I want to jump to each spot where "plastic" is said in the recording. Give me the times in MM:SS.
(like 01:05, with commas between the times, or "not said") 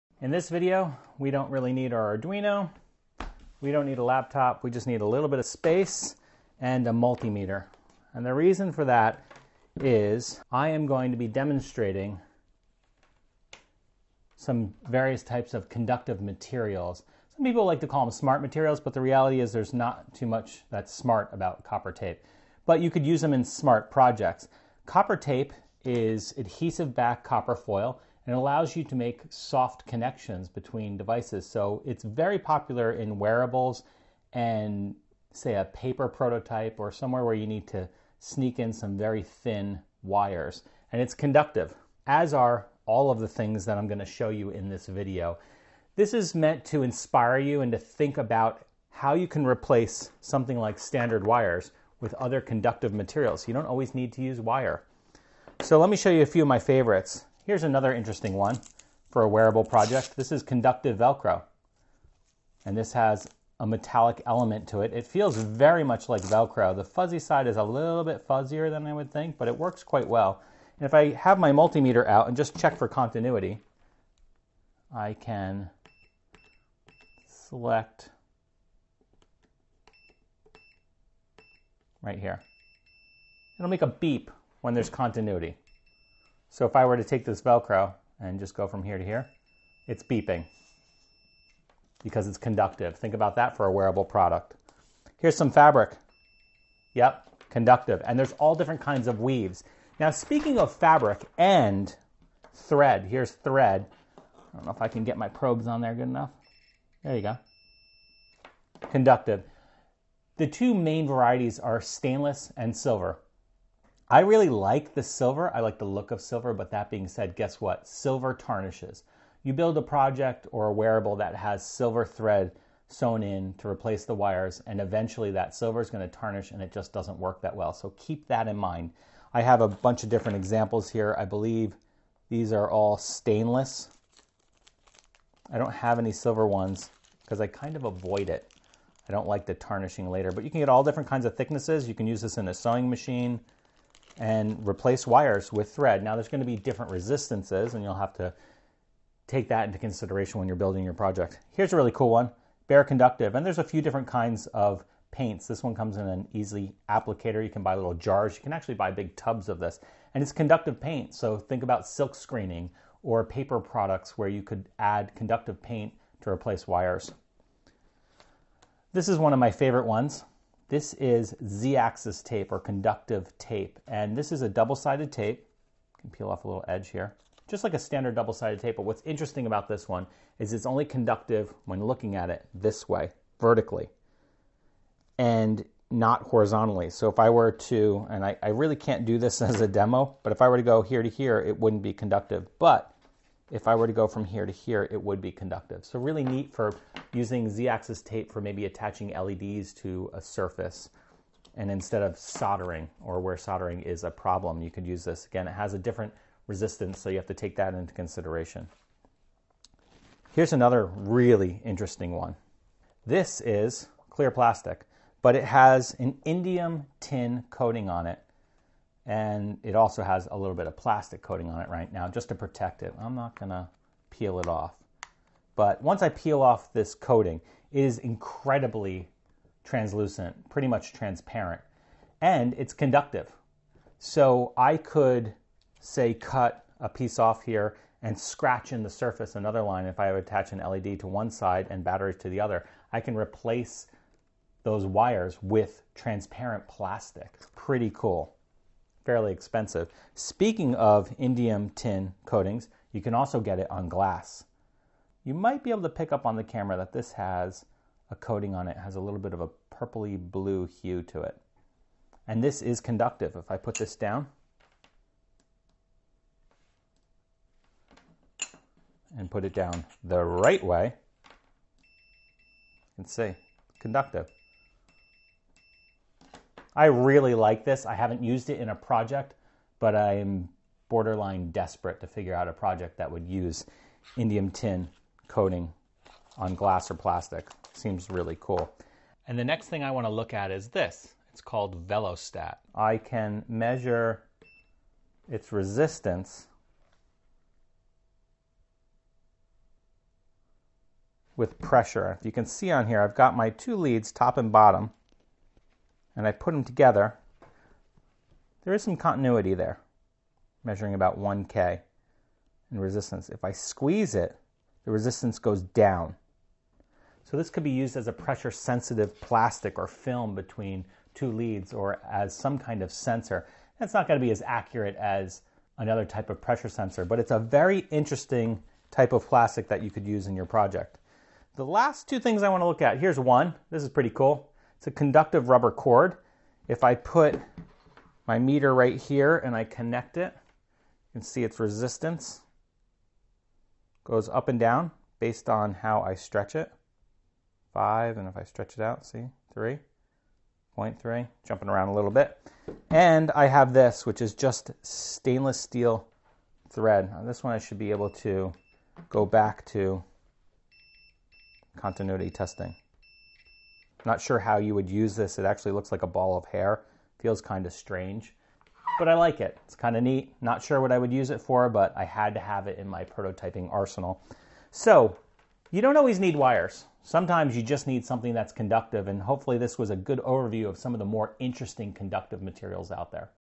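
03:34, 03:40, 04:06, 04:46, 05:19, 05:29.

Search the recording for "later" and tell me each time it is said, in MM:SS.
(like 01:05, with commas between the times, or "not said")
02:20.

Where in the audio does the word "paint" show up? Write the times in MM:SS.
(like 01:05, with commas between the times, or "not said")
02:35, 02:40, 02:45.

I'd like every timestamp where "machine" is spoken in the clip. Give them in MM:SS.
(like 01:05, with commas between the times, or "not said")
02:22.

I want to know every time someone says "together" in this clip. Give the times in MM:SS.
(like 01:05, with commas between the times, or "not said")
05:06.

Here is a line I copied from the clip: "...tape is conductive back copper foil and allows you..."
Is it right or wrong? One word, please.
wrong.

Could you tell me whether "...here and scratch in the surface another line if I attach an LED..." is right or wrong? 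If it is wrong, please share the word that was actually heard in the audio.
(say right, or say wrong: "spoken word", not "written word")
right.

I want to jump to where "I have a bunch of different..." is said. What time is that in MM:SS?
02:09.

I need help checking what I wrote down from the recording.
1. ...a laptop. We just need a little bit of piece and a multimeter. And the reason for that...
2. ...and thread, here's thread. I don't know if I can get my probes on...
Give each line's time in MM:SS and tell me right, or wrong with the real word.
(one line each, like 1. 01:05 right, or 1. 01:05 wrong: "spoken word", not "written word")
1. 00:03 wrong: "space", not "piece"
2. 01:41 right.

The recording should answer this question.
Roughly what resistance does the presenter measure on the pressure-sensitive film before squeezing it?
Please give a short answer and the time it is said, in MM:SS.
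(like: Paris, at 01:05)
1K, at 05:11.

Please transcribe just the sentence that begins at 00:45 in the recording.
This is meant to inspire you and to think about how you can replace something like standard wires with other conductive materials.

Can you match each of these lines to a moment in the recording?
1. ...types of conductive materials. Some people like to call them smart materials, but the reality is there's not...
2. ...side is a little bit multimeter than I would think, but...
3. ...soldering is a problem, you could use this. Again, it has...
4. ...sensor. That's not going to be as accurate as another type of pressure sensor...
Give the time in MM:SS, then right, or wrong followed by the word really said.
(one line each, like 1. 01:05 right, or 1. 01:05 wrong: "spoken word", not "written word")
1. 00:15 right
2. 01:07 wrong: "fuzzier", not "multimeter"
3. 03:23 right
4. 05:22 right.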